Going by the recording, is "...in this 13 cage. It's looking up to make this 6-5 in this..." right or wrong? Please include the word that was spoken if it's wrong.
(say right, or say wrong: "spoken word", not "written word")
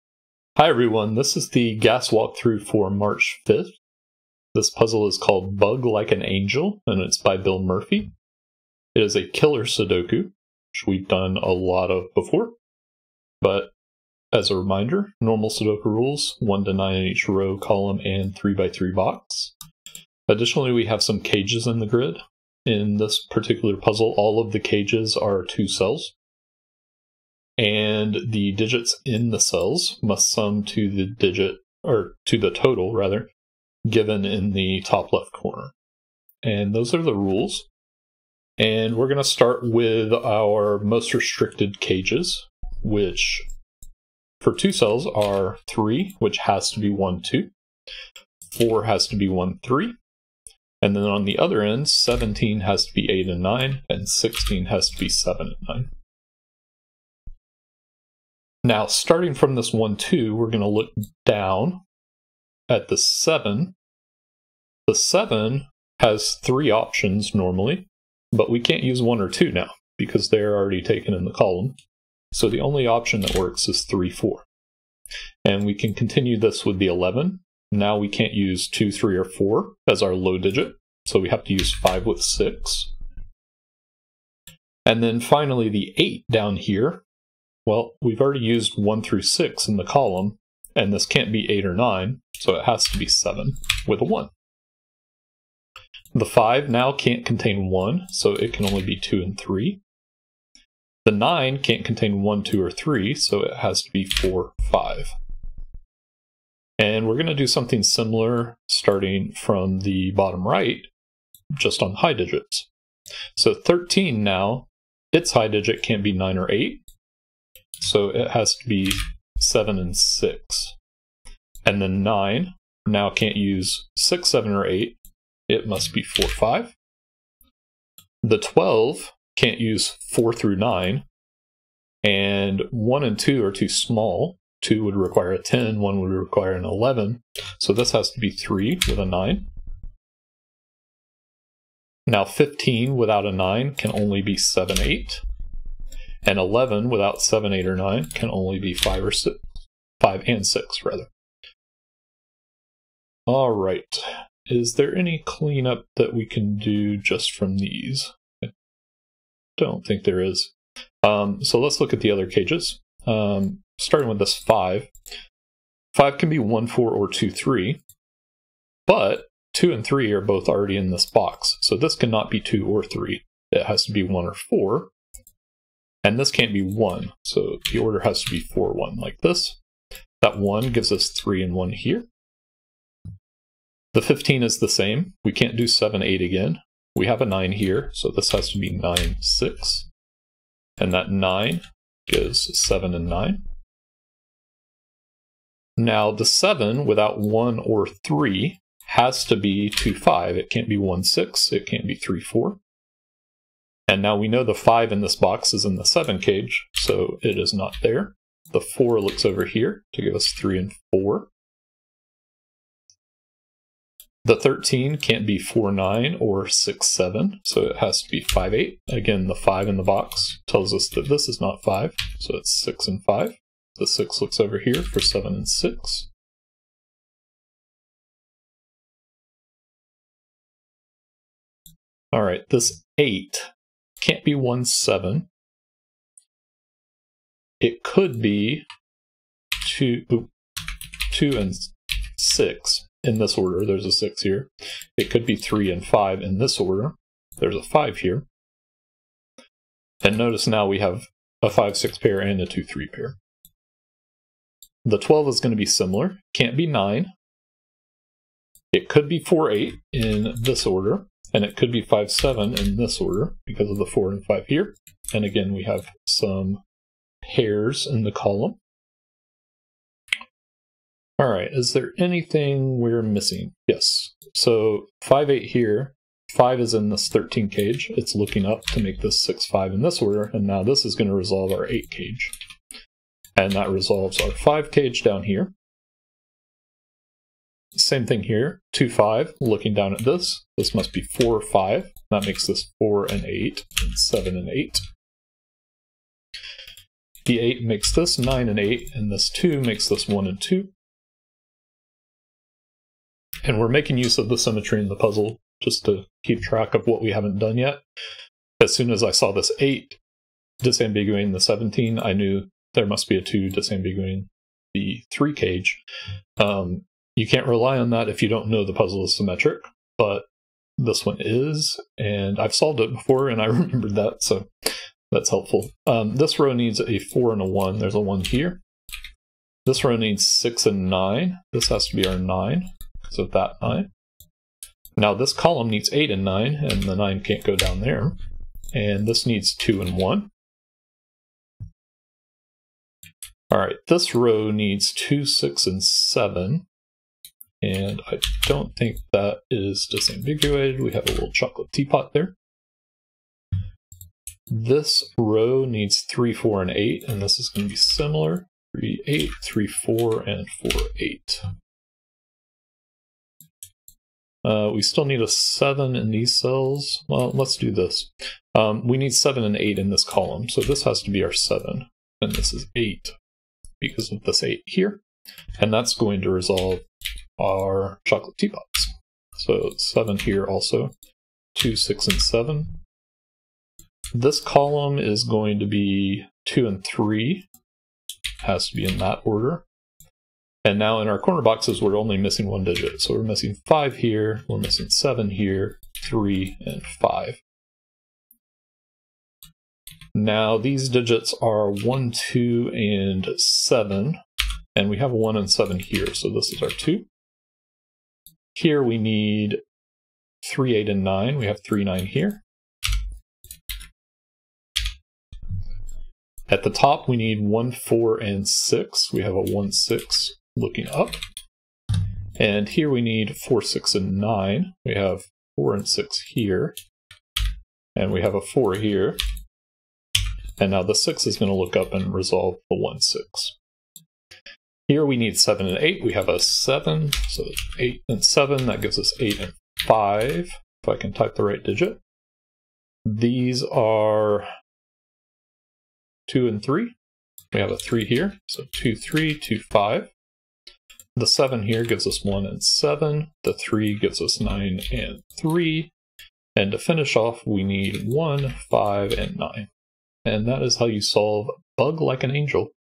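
right.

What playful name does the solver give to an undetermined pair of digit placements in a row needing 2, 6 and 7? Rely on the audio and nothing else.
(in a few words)
chocolate teapot.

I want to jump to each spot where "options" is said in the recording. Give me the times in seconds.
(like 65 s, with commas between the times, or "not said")
66 s, 72 s.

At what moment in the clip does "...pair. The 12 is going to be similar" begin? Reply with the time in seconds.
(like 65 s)
252 s.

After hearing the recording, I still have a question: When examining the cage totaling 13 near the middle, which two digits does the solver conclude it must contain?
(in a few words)
5 and 8.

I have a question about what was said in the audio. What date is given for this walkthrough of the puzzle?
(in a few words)
March 5th.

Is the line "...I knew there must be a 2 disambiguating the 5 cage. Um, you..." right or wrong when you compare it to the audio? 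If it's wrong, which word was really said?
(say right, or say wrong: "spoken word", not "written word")
wrong: "3", not "5".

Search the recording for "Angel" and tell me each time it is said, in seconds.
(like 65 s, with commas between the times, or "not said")
6 s, 462 s.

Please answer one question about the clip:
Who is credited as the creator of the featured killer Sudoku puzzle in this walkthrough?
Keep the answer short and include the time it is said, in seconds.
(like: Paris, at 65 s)
Bill Murphy, at 7 s.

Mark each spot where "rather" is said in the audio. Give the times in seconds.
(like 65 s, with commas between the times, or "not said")
32 s, 150 s.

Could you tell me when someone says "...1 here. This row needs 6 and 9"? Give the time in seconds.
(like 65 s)
327 s.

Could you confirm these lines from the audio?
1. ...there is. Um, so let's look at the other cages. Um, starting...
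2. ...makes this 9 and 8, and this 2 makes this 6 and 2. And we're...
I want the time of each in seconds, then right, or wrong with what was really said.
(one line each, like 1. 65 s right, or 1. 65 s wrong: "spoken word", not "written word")
1. 160 s right
2. 297 s wrong: "1", not "6".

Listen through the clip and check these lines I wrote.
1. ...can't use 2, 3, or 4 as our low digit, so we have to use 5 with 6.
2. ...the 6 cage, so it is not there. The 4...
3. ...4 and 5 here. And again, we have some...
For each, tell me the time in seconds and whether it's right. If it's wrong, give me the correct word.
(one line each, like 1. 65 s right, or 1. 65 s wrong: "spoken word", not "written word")
1. 78 s right
2. 205 s wrong: "7", not "6"
3. 263 s right.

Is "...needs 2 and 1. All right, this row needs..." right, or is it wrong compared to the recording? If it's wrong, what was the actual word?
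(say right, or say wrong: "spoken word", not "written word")
right.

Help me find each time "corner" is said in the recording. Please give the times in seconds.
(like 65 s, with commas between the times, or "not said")
35 s, 391 s.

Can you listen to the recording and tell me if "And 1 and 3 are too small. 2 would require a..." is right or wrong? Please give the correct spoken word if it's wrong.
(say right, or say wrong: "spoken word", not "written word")
wrong: "2", not "3".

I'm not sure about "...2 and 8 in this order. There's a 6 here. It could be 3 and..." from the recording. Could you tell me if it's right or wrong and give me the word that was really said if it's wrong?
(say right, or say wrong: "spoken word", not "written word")
wrong: "6", not "8".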